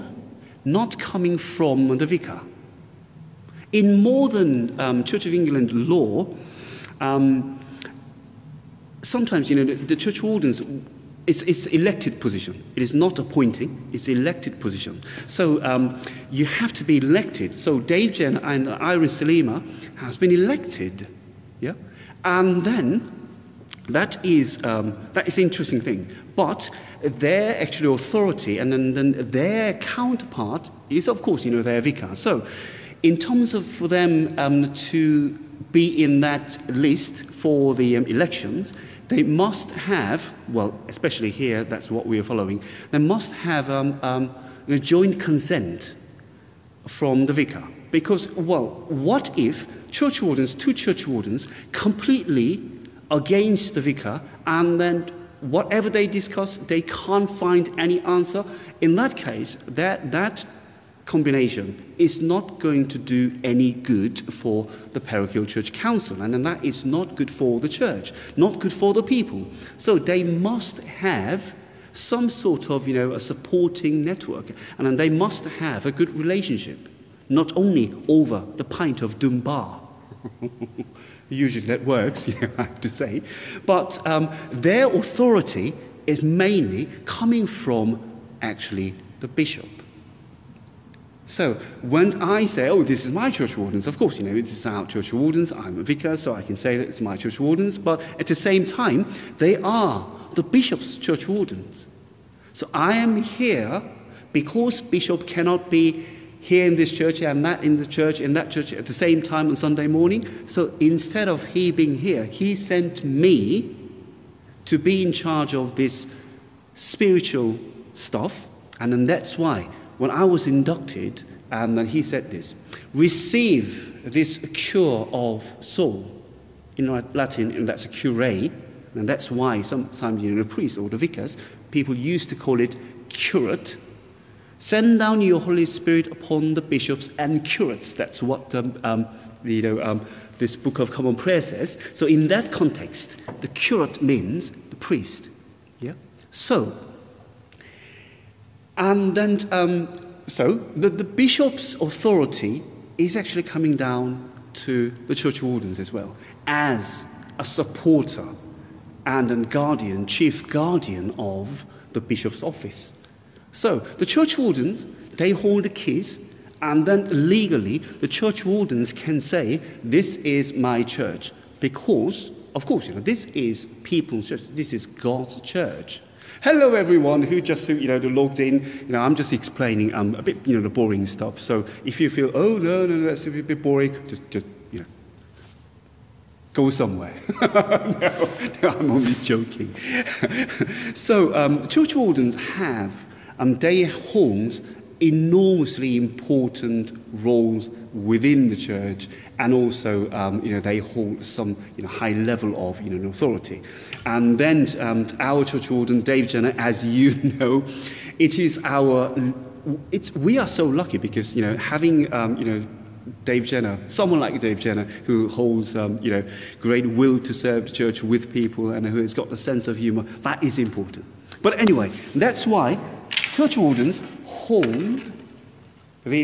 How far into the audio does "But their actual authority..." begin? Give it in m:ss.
0:26.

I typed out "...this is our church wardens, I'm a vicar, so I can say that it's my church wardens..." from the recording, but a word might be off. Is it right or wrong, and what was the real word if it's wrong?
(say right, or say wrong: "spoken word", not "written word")
right.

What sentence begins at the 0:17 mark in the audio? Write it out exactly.
So Dave Jen and Iris Salima has been elected, yeah.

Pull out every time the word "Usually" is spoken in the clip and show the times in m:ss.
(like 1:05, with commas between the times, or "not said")
1:21.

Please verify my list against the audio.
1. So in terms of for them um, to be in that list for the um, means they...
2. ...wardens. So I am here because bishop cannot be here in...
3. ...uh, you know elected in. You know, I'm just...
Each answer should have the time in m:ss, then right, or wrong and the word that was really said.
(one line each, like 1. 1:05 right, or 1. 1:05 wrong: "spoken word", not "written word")
1. 0:32 wrong: "elections", not "means"
2. 1:41 right
3. 2:57 wrong: "logged", not "elected".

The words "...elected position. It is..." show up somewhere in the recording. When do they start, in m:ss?
0:11.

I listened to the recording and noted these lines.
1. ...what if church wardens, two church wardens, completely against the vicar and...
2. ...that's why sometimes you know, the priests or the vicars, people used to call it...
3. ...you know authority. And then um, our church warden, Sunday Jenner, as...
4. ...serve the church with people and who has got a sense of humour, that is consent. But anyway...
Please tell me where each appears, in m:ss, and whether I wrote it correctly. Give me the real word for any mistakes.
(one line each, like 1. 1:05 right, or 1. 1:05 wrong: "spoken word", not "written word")
1. 0:48 right
2. 2:09 right
3. 3:22 wrong: "Dave", not "Sunday"
4. 3:37 wrong: "important", not "consent".